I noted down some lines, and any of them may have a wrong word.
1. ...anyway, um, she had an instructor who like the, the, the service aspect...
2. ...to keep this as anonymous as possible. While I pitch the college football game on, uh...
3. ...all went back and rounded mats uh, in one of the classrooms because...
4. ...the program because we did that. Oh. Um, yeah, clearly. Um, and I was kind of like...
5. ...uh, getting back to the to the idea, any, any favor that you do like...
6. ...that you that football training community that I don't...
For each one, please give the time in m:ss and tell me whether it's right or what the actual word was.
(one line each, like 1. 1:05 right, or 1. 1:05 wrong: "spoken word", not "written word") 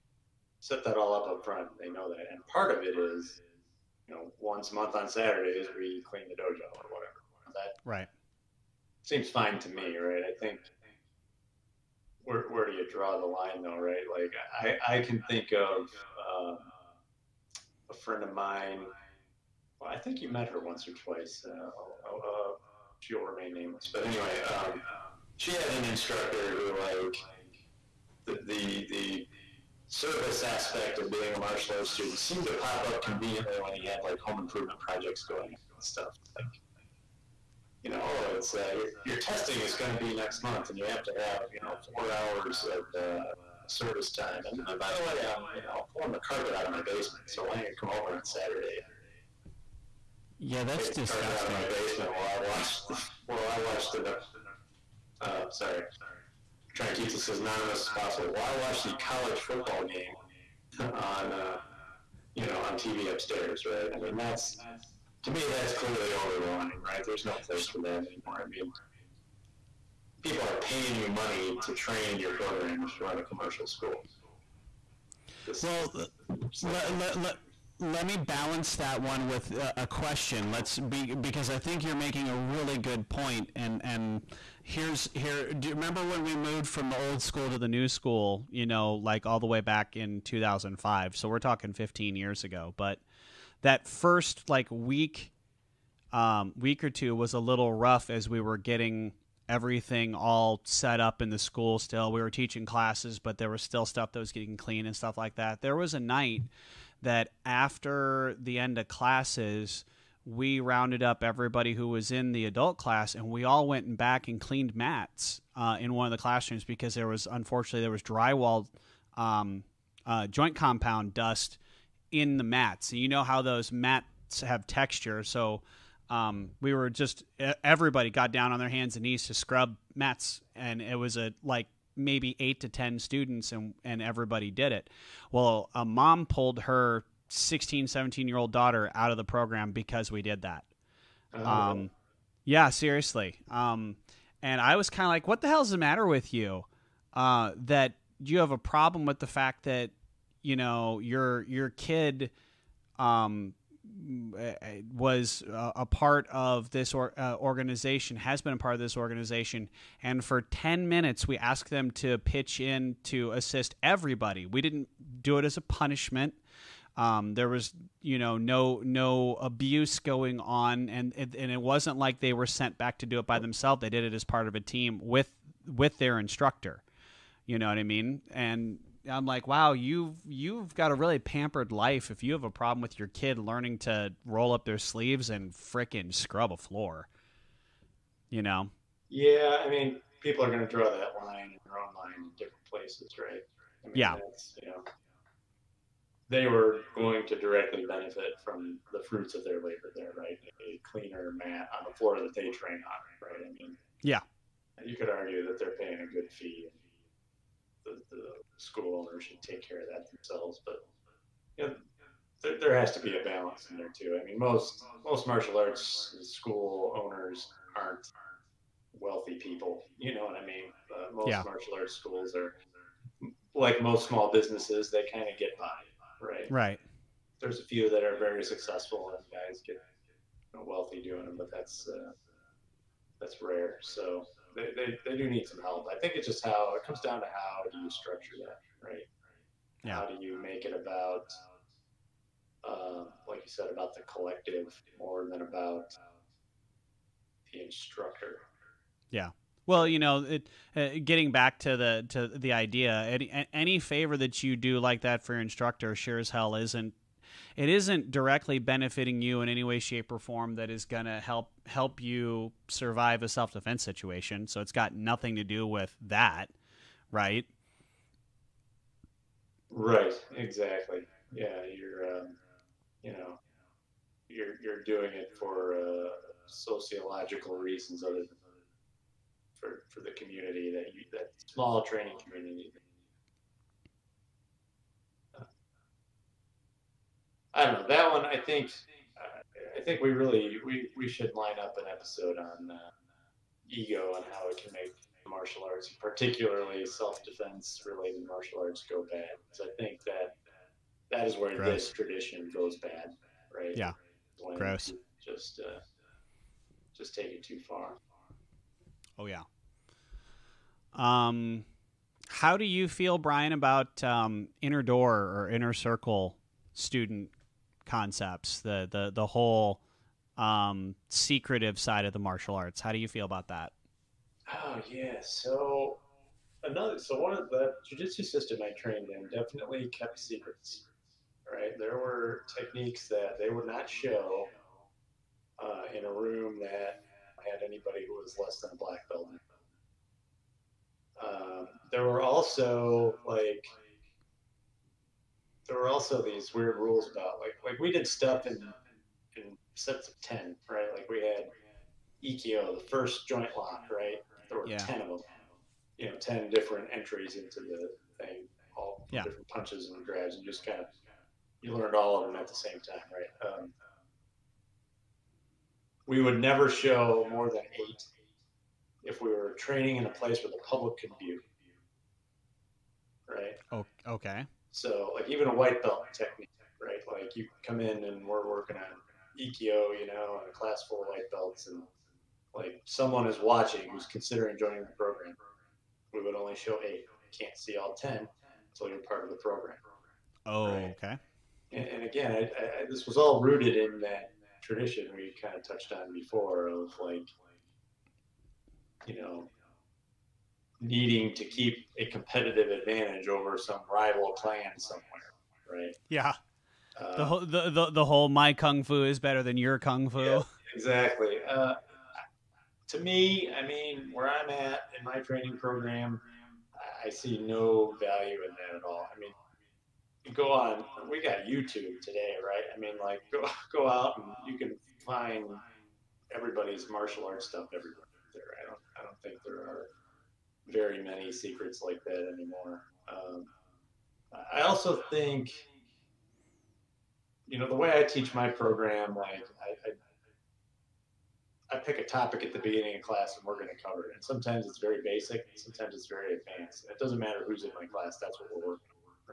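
1. 0:24 right
2. 0:56 wrong: "watch", not "pitch"
3. 1:53 wrong: "cleaned", not "rounded"
4. 2:19 wrong: "seriously", not "clearly"
5. 4:10 right
6. 4:40 wrong: "small", not "football".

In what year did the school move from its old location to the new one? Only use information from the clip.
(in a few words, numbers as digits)
2005.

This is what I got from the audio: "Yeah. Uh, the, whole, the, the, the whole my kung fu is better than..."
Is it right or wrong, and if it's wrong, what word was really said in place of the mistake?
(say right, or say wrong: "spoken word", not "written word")
right.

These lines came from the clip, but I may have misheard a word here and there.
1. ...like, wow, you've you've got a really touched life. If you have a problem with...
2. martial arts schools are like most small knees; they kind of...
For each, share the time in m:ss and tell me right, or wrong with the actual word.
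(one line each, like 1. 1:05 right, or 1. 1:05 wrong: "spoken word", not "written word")
1. 2:59 wrong: "pampered", not "touched"
2. 3:41 wrong: "businesses", not "knees".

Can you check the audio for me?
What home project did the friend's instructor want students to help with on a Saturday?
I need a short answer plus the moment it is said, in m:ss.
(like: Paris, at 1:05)
Pulling the carpet, at 0:45.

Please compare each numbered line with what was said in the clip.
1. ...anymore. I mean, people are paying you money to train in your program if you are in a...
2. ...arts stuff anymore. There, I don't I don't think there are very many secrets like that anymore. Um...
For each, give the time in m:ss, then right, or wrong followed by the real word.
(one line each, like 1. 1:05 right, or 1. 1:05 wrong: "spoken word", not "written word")
1. 1:07 right
2. 7:07 wrong: "everywhere", not "anymore".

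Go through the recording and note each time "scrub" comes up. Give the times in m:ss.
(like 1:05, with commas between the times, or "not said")
2:09, 3:06.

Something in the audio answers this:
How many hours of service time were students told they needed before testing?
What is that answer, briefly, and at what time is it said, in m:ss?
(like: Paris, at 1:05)
4, at 0:41.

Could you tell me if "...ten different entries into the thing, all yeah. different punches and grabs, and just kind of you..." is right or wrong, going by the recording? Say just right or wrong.
right.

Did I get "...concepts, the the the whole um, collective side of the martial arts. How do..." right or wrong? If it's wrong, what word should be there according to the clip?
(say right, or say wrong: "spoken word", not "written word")
wrong: "secretive", not "collective".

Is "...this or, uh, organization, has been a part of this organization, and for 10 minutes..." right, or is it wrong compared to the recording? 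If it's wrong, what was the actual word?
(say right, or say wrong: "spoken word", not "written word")
right.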